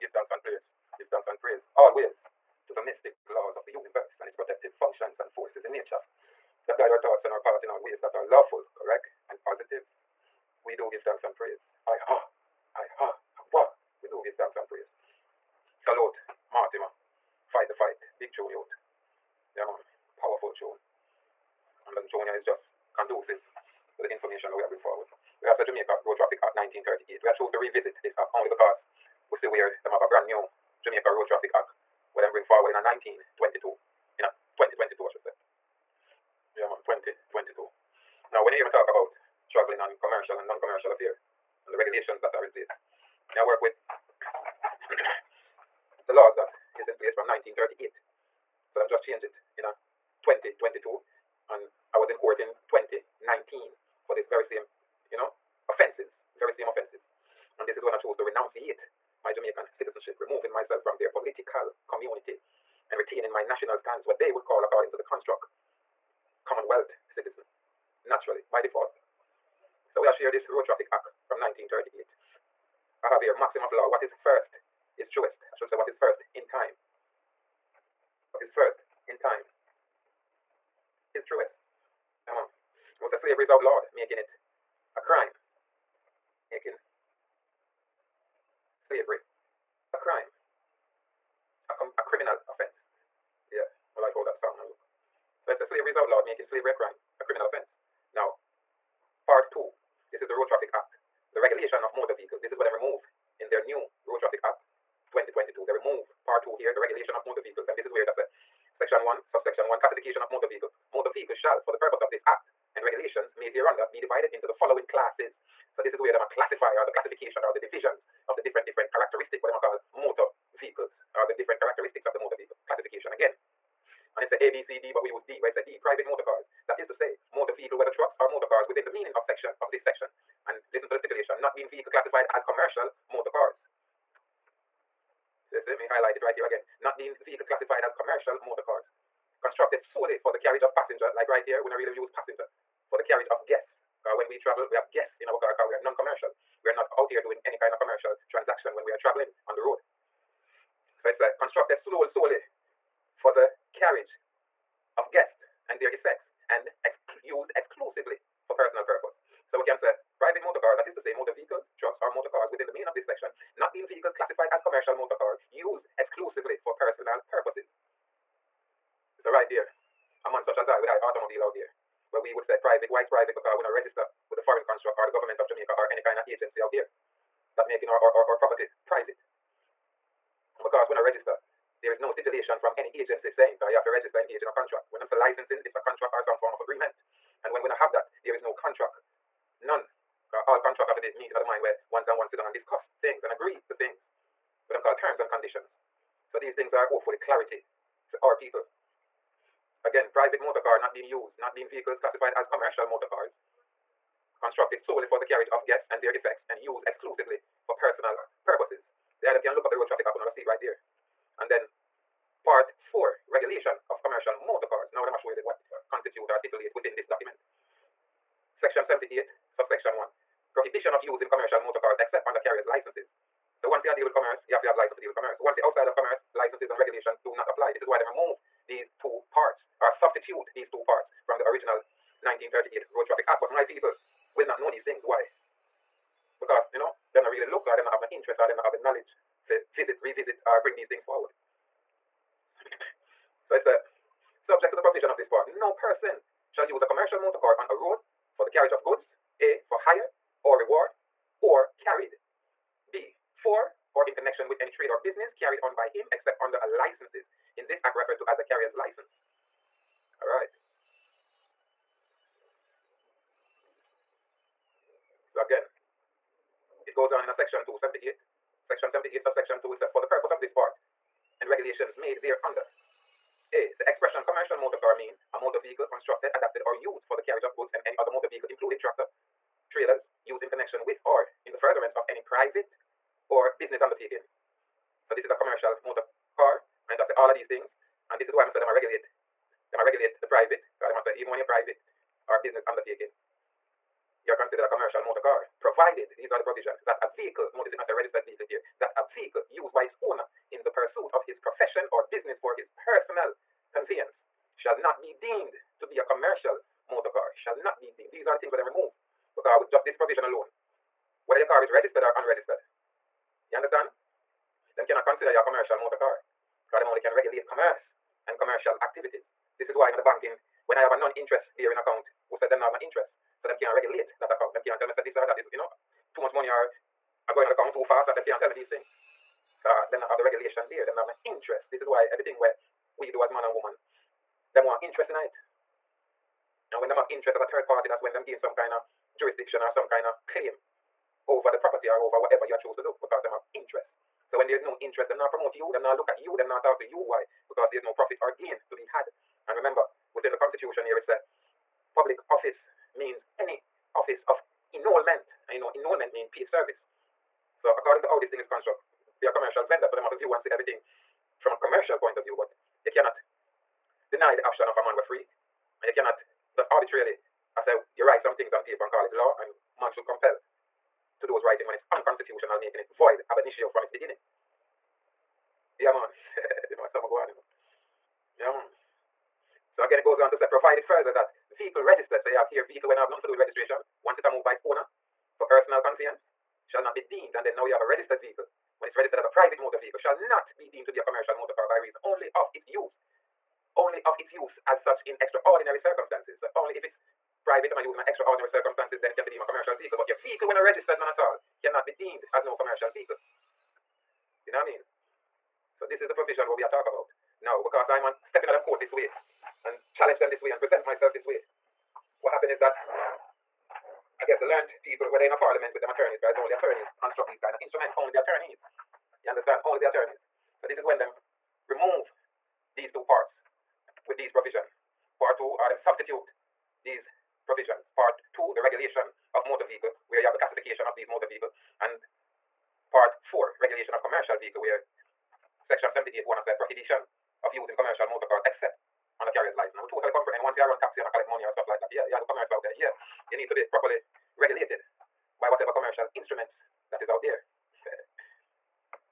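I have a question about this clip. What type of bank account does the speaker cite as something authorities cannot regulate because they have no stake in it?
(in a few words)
non-interest bearing account.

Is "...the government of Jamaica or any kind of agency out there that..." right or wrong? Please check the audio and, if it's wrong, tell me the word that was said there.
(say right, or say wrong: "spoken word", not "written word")
right.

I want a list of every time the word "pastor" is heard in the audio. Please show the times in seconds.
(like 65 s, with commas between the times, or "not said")
not said.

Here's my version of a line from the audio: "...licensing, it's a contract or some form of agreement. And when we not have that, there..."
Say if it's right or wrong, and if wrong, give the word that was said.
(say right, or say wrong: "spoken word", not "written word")
right.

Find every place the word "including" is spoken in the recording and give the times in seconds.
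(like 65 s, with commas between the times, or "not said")
278 s.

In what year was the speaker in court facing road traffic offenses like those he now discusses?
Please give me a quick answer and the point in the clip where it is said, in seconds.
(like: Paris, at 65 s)
2019, at 52 s.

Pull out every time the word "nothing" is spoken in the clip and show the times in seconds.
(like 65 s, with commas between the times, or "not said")
383 s.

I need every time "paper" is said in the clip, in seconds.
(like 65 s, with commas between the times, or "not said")
368 s.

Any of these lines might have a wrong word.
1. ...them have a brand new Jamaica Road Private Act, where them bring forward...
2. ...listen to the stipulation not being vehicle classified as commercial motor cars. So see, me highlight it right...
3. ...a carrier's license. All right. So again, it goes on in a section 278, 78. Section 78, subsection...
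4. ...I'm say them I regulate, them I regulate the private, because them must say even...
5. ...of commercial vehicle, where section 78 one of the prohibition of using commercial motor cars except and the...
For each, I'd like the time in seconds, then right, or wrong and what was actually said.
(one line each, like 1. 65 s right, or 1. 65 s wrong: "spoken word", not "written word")
1. 29 s wrong: "Traffic", not "Private"
2. 130 s right
3. 258 s right
4. 288 s right
5. 433 s right.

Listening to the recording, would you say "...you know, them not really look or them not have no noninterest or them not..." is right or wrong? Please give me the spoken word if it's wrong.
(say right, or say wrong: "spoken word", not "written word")
wrong: "interest", not "noninterest".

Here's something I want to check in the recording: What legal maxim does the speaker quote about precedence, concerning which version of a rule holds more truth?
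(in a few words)
What is first in time is truest.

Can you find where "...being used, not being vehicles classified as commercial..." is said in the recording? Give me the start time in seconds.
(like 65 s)
200 s.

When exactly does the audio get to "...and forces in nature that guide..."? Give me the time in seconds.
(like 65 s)
5 s.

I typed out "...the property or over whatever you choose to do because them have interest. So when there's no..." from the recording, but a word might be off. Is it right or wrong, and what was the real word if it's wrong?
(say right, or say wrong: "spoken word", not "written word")
right.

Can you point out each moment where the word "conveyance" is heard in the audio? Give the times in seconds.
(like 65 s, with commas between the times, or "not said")
303 s, 385 s.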